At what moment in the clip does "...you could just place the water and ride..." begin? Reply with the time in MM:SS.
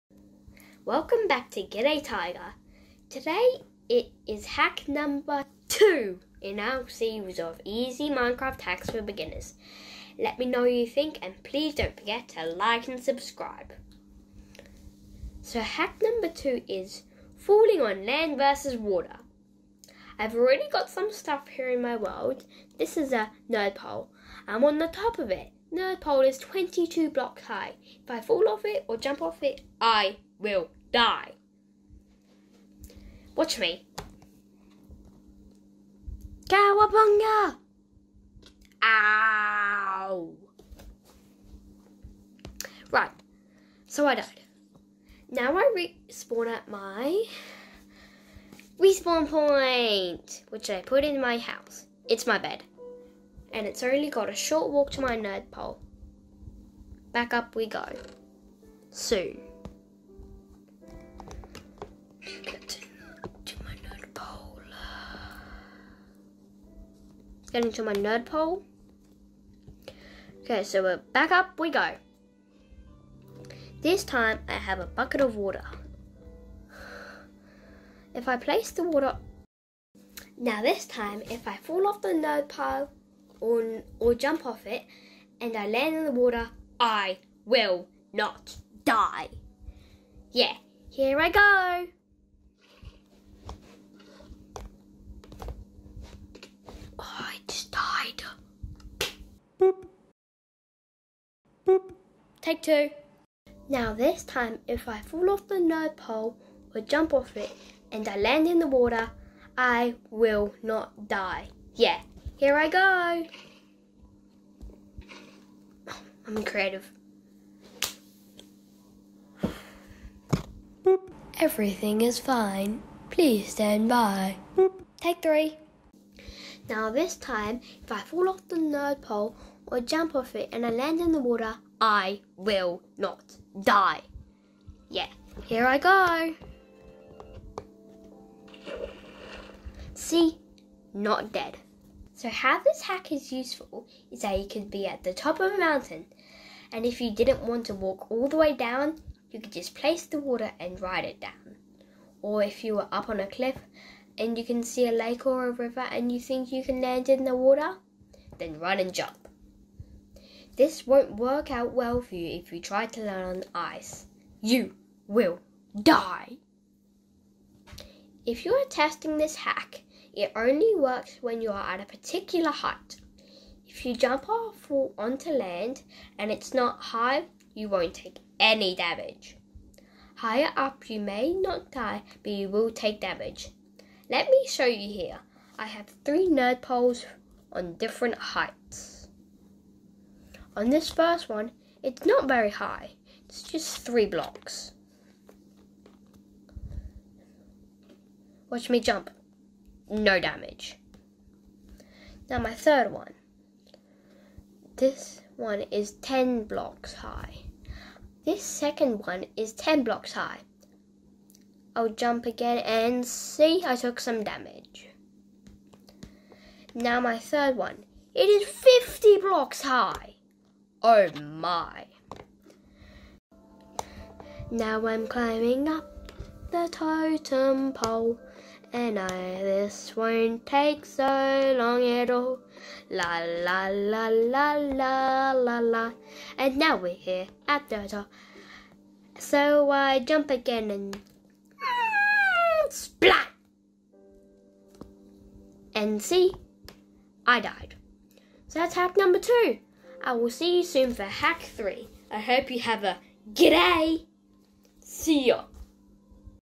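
02:29.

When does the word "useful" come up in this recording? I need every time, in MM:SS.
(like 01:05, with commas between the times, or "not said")
02:23.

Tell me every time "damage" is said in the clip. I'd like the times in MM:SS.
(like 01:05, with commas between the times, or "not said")
02:58, 03:02, 03:20, 03:34.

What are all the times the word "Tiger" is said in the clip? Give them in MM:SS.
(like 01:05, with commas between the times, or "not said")
00:02.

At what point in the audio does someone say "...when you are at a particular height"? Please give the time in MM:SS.
02:51.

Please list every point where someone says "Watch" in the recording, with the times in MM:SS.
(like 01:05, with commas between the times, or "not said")
00:33, 03:18.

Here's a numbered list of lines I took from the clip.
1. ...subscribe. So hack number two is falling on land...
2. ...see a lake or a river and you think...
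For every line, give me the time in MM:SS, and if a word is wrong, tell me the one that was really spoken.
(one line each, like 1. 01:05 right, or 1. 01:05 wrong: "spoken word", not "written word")
1. 00:13 right
2. 02:34 right.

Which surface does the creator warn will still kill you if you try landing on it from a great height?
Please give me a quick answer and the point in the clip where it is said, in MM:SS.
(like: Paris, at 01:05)
Ice, at 02:43.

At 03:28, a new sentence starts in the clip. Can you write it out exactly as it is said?
This second one is 10 blocks high.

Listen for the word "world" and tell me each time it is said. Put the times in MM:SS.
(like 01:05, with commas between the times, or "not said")
00:21.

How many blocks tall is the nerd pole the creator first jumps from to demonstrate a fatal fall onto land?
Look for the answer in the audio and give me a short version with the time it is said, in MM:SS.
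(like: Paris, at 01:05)
22, at 00:26.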